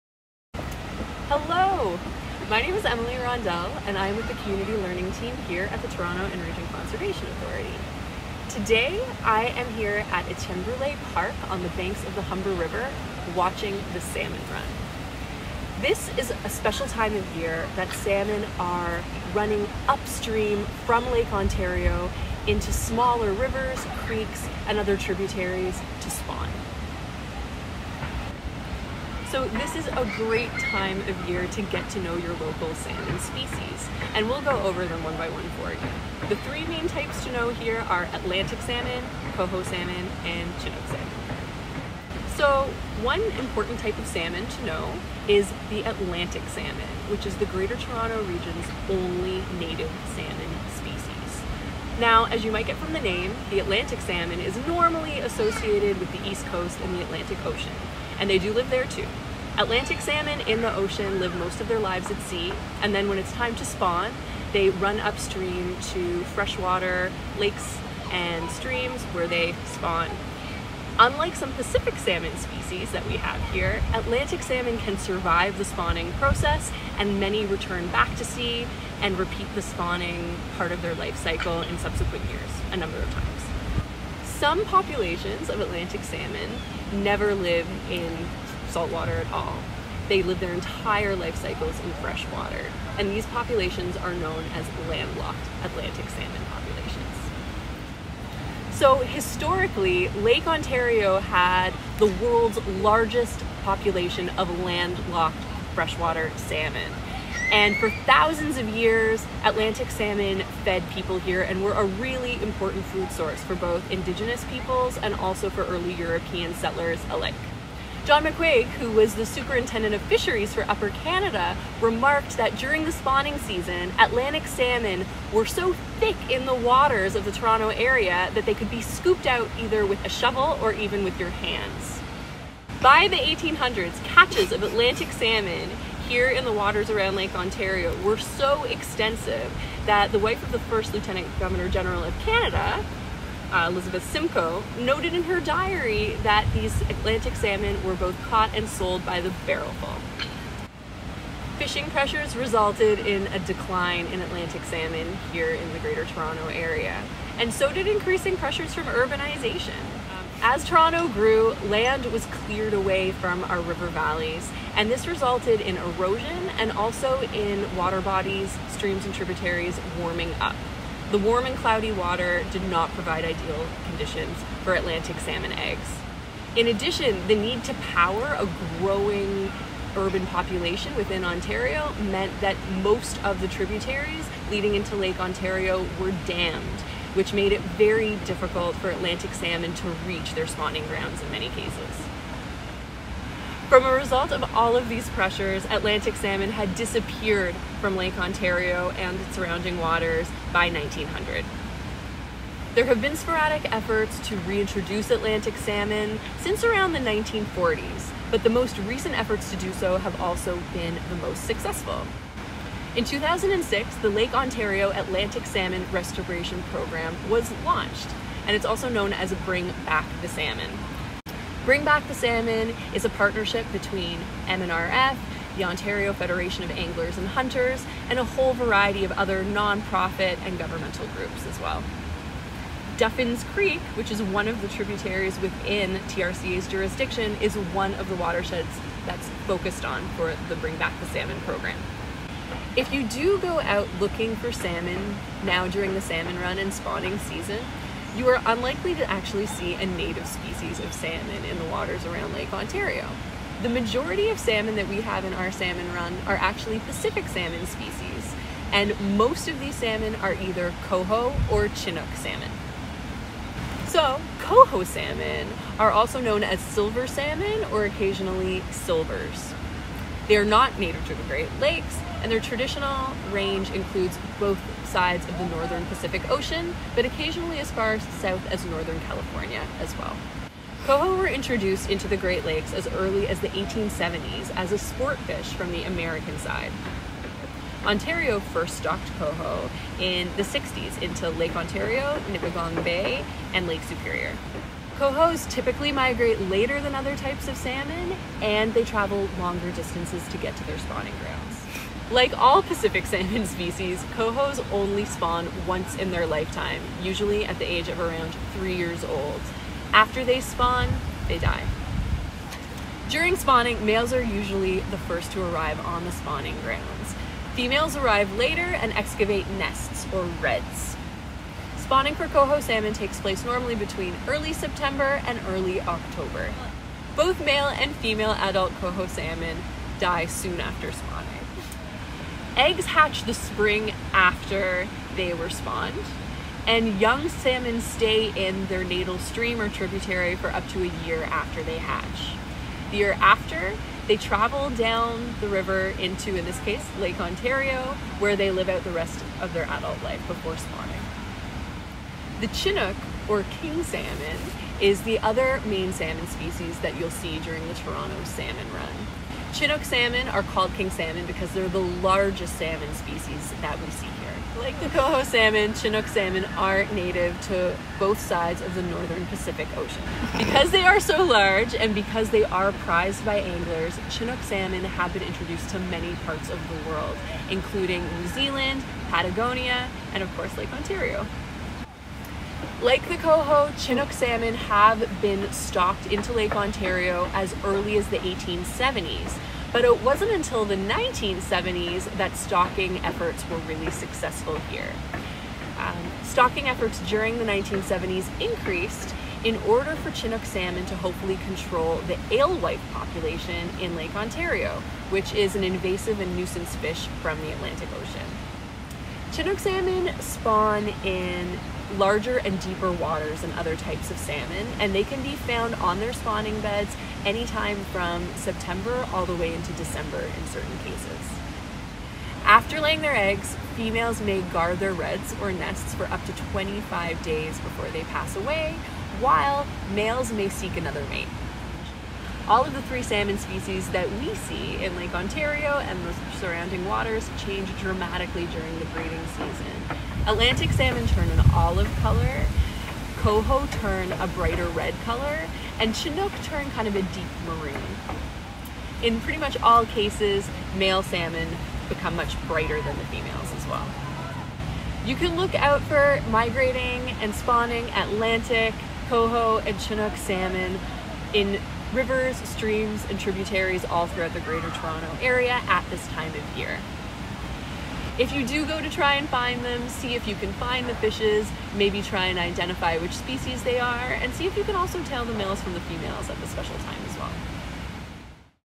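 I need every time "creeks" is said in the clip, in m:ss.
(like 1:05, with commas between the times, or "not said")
0:23, 3:53.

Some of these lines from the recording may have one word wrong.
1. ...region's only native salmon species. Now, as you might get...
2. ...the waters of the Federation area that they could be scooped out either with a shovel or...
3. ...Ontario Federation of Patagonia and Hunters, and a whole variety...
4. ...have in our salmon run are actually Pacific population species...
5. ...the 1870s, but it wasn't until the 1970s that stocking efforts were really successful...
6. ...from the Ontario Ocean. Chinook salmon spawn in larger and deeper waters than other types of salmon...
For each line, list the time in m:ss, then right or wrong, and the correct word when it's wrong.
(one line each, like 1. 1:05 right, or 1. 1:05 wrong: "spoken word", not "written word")
1. 0:48 right
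2. 2:06 wrong: "Toronto", not "Federation"
3. 3:45 wrong: "Anglers", not "Patagonia"
4. 4:15 wrong: "salmon", not "population"
5. 6:28 right
6. 6:47 wrong: "Atlantic", not "Ontario".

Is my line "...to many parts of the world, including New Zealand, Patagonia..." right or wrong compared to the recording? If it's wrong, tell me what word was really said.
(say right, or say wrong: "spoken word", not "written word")
right.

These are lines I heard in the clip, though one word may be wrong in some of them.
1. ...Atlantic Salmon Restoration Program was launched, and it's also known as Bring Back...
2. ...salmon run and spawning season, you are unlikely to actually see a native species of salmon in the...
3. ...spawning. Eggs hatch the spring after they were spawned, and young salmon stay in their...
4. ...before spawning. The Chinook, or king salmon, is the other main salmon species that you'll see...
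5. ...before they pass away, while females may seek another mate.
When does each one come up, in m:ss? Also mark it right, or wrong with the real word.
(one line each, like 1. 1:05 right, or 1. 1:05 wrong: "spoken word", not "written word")
1. 3:34 right
2. 4:06 right
3. 5:30 right
4. 5:50 right
5. 7:07 wrong: "males", not "females".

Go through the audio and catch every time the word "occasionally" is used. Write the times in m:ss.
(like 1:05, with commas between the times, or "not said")
4:27, 4:37.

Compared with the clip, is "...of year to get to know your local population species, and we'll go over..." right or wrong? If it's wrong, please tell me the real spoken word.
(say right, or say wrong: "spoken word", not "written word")
wrong: "salmon", not "population".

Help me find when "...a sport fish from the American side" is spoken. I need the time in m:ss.
4:44.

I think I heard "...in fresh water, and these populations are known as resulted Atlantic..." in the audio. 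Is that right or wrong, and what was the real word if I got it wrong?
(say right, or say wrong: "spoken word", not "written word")
wrong: "landlocked", not "resulted".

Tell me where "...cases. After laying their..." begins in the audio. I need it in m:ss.
7:00.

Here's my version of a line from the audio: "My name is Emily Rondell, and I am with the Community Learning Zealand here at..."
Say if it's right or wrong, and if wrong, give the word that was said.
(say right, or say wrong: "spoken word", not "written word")
wrong: "Team", not "Zealand".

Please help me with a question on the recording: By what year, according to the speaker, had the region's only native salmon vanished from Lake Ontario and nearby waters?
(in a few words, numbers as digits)
1900.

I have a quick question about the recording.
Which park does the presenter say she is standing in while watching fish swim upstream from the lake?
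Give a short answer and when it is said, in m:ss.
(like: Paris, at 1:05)
Etienne Park, at 0:10.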